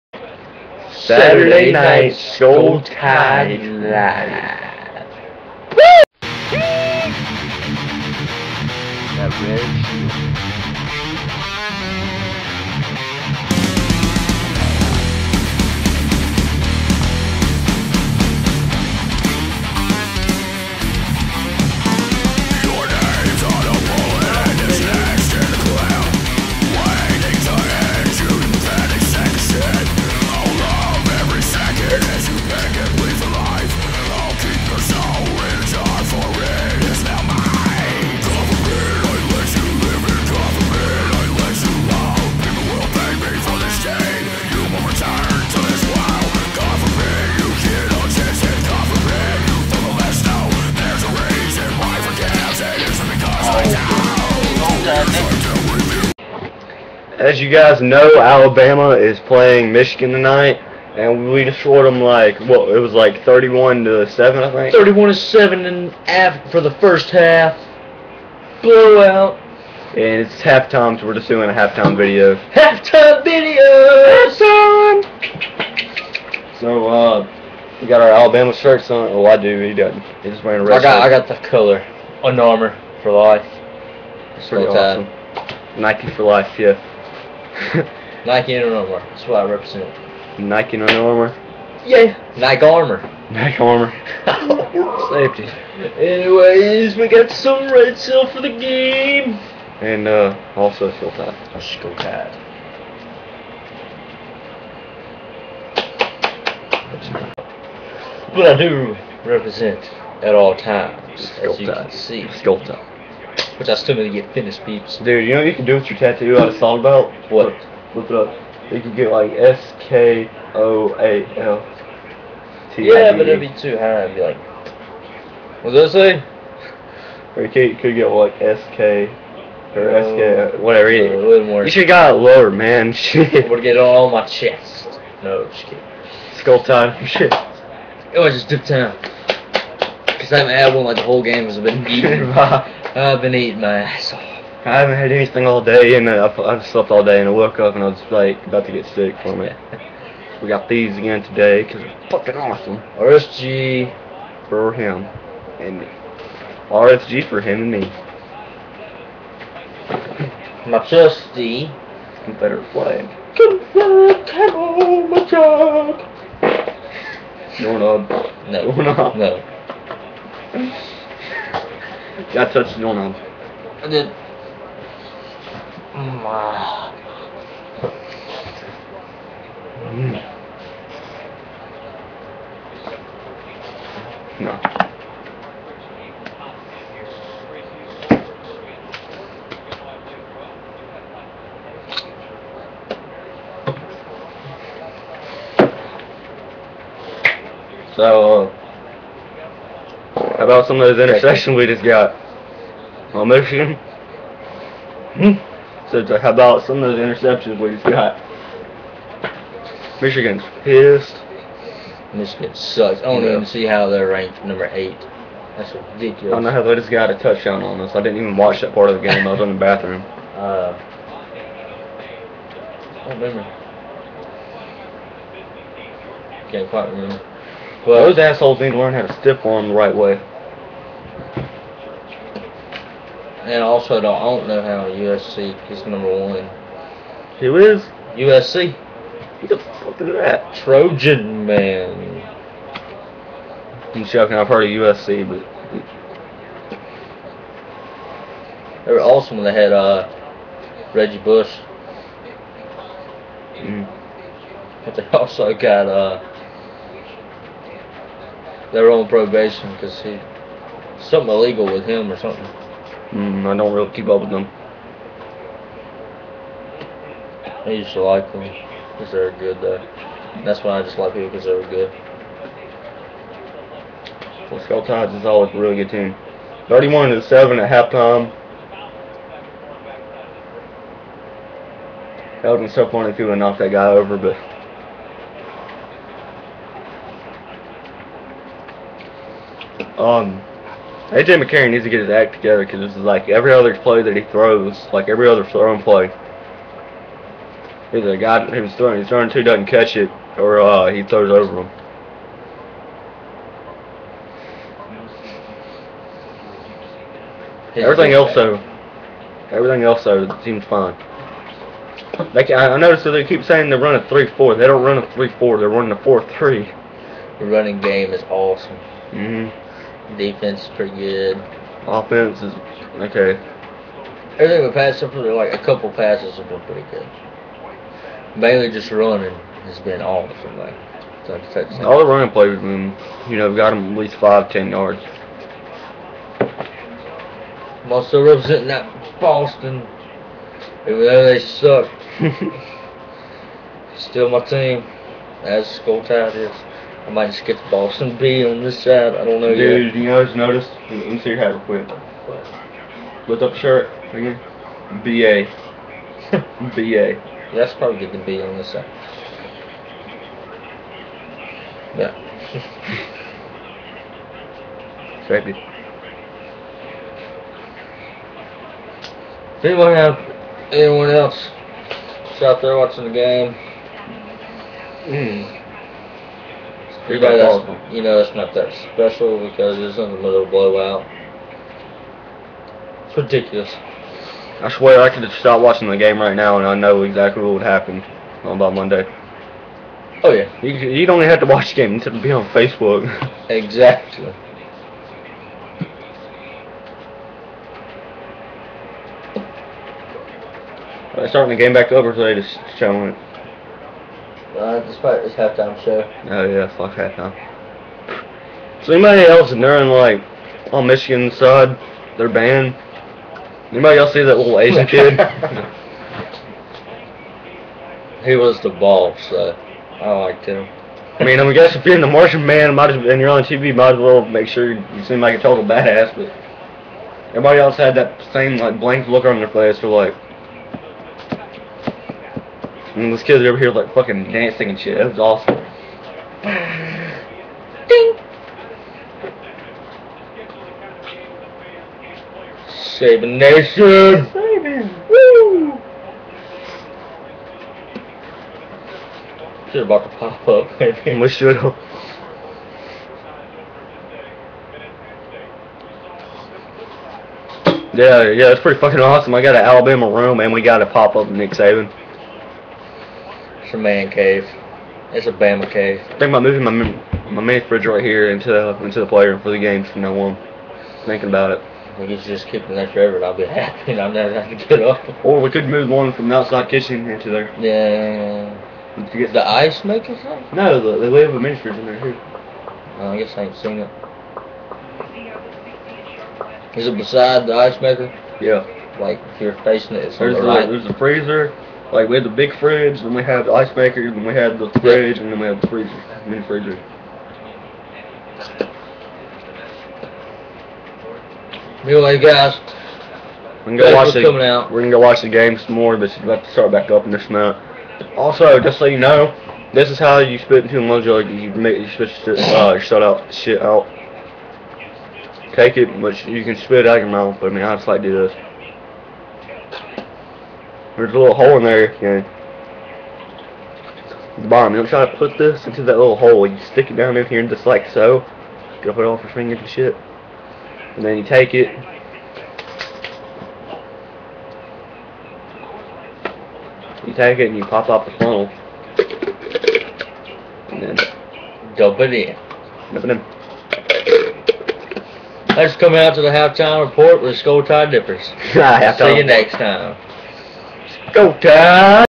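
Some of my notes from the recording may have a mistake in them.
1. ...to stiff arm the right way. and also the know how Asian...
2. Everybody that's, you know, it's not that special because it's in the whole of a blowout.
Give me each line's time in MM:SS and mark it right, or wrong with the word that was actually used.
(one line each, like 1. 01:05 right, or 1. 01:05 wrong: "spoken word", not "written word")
1. 03:49 wrong: "USC", not "Asian"
2. 06:17 wrong: "middle", not "whole".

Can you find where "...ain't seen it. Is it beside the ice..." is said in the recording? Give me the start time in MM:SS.
08:03.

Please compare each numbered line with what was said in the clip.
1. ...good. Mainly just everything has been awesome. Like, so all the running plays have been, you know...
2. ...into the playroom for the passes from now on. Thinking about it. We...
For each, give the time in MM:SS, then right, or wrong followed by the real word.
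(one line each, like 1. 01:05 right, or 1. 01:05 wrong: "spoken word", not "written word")
1. 05:26 wrong: "running", not "everything"
2. 07:48 wrong: "games", not "passes".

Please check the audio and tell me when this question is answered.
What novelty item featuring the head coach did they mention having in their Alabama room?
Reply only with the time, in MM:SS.
07:40.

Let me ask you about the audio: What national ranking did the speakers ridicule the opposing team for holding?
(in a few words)
8.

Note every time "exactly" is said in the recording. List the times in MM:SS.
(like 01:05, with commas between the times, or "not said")
06:27, 06:33.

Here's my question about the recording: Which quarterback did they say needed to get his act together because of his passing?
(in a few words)
AJ McCarron.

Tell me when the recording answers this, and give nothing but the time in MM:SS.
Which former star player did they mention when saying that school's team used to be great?
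04:10.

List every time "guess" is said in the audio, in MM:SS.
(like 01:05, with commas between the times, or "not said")
07:01, 08:03.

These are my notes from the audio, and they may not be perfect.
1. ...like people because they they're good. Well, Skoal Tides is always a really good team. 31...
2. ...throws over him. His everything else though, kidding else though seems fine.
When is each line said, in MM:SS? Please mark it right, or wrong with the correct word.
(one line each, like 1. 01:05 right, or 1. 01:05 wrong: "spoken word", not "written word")
1. 04:30 right
2. 05:01 wrong: "everything", not "kidding".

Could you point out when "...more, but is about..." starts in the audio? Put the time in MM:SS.
08:25.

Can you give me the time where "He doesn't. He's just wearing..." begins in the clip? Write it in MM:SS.
01:19.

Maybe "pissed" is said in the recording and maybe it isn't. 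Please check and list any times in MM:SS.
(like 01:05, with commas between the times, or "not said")
03:30.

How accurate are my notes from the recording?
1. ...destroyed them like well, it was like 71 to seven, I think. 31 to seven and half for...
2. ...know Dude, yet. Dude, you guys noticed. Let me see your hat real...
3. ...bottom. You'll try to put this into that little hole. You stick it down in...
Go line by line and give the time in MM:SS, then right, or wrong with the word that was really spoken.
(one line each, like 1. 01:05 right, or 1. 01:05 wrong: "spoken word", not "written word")
1. 01:01 wrong: "31", not "71"
2. 05:49 right
3. 08:44 right.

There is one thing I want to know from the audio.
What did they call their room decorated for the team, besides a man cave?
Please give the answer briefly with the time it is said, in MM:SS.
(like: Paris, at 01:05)
Bama cave, at 07:45.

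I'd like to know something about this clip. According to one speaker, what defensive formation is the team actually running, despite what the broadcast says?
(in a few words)
four-three.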